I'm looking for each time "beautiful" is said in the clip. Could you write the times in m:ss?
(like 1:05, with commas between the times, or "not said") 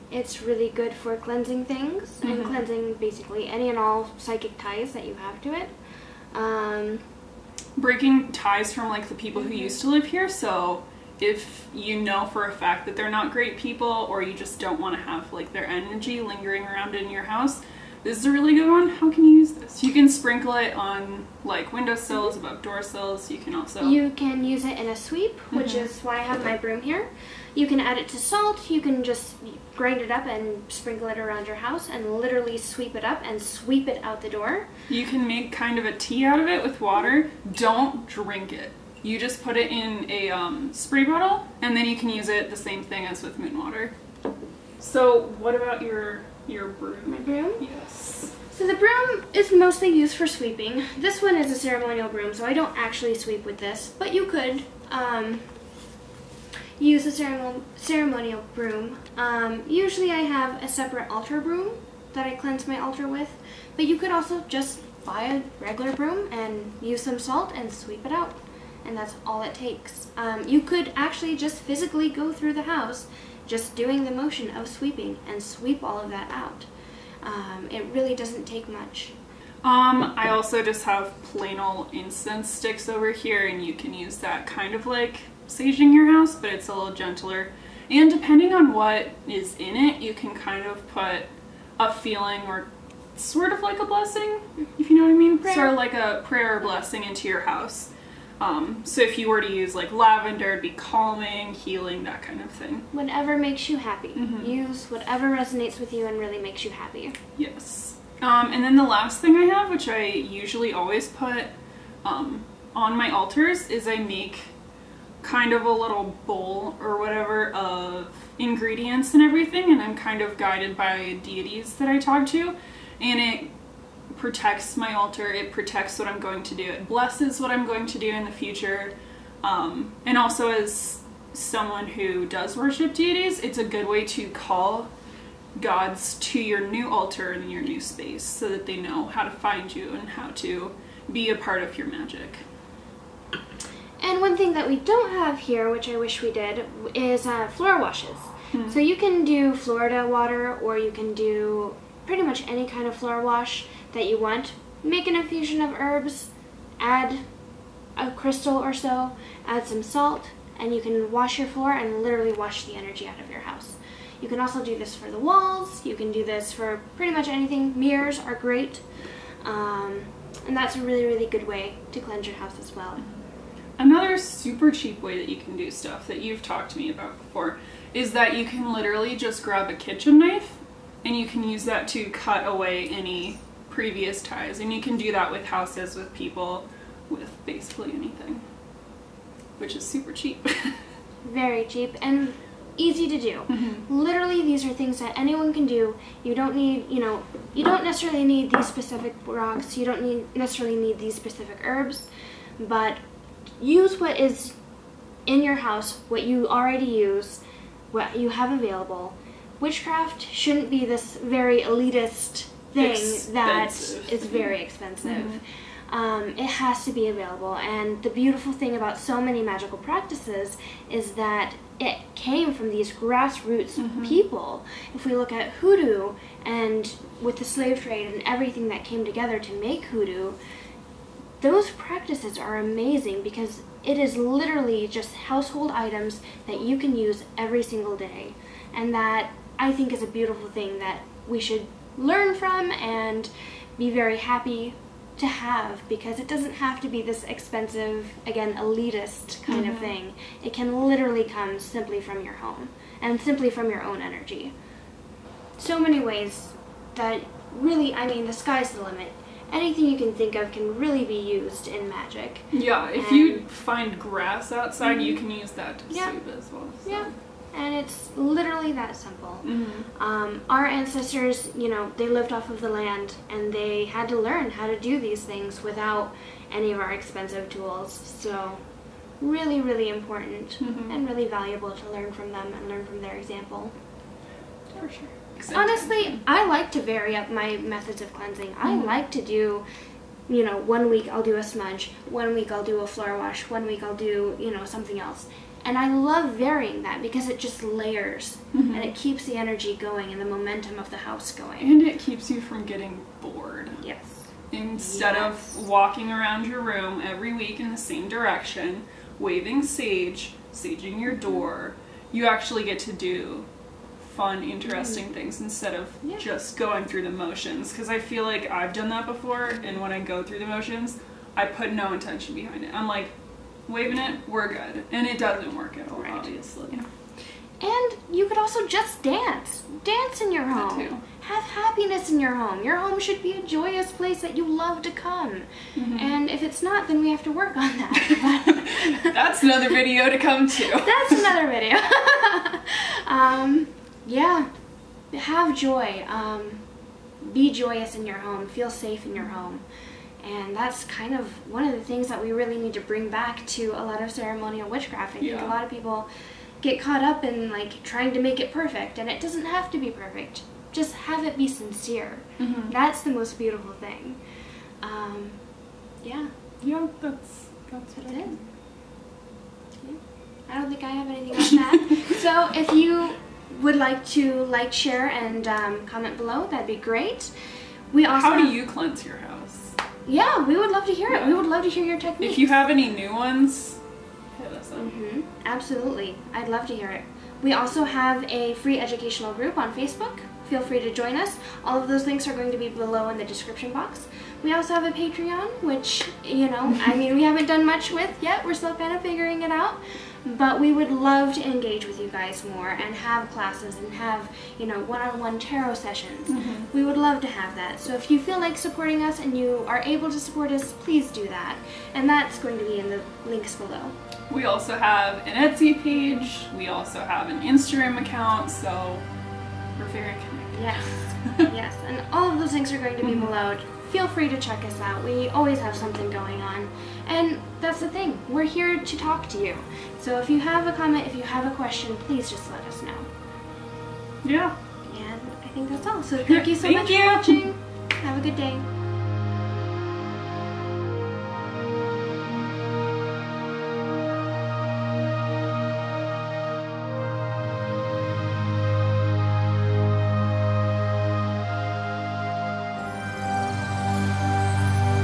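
3:38, 4:00, 6:03.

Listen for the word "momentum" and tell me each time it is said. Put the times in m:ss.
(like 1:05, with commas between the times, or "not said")
5:00.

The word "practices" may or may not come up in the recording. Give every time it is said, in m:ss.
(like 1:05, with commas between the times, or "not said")
3:39, 3:51.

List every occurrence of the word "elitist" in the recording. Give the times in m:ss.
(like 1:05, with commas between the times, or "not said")
3:31, 4:08.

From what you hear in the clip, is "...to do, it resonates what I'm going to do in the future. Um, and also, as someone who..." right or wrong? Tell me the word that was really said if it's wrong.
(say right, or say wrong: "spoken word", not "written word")
wrong: "blesses", not "resonates".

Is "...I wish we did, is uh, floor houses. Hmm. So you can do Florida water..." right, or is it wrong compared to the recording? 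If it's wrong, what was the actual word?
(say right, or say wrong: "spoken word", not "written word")
wrong: "washes", not "houses".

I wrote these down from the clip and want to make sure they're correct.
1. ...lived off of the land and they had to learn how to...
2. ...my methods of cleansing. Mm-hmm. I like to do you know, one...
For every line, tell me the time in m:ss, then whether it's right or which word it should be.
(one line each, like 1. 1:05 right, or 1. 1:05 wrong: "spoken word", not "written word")
1. 4:32 right
2. 4:47 right.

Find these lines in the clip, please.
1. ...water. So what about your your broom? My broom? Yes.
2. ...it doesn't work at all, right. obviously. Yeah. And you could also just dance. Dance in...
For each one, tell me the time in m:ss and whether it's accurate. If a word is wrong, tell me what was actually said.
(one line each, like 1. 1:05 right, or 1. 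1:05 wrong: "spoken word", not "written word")
1. 0:43 right
2. 5:25 right.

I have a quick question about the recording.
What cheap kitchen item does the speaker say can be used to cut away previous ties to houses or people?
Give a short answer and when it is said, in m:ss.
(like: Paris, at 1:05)
kitchen knife, at 2:59.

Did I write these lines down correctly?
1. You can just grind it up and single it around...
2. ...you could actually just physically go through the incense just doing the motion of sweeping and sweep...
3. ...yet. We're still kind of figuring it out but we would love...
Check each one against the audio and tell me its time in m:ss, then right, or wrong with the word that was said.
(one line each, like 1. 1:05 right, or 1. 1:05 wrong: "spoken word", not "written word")
1. 0:28 wrong: "sprinkle", not "single"
2. 1:10 wrong: "house", not "incense"
3. 6:38 right.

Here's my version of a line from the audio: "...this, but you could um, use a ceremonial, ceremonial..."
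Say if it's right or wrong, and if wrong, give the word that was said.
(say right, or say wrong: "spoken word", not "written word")
right.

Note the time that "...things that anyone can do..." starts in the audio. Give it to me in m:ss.
3:14.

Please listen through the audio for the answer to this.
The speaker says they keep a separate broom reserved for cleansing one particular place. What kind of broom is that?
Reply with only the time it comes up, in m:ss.
1:01.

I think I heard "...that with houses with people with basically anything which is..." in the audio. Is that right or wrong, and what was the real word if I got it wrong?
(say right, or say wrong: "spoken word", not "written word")
right.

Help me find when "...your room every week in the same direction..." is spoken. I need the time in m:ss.
5:06.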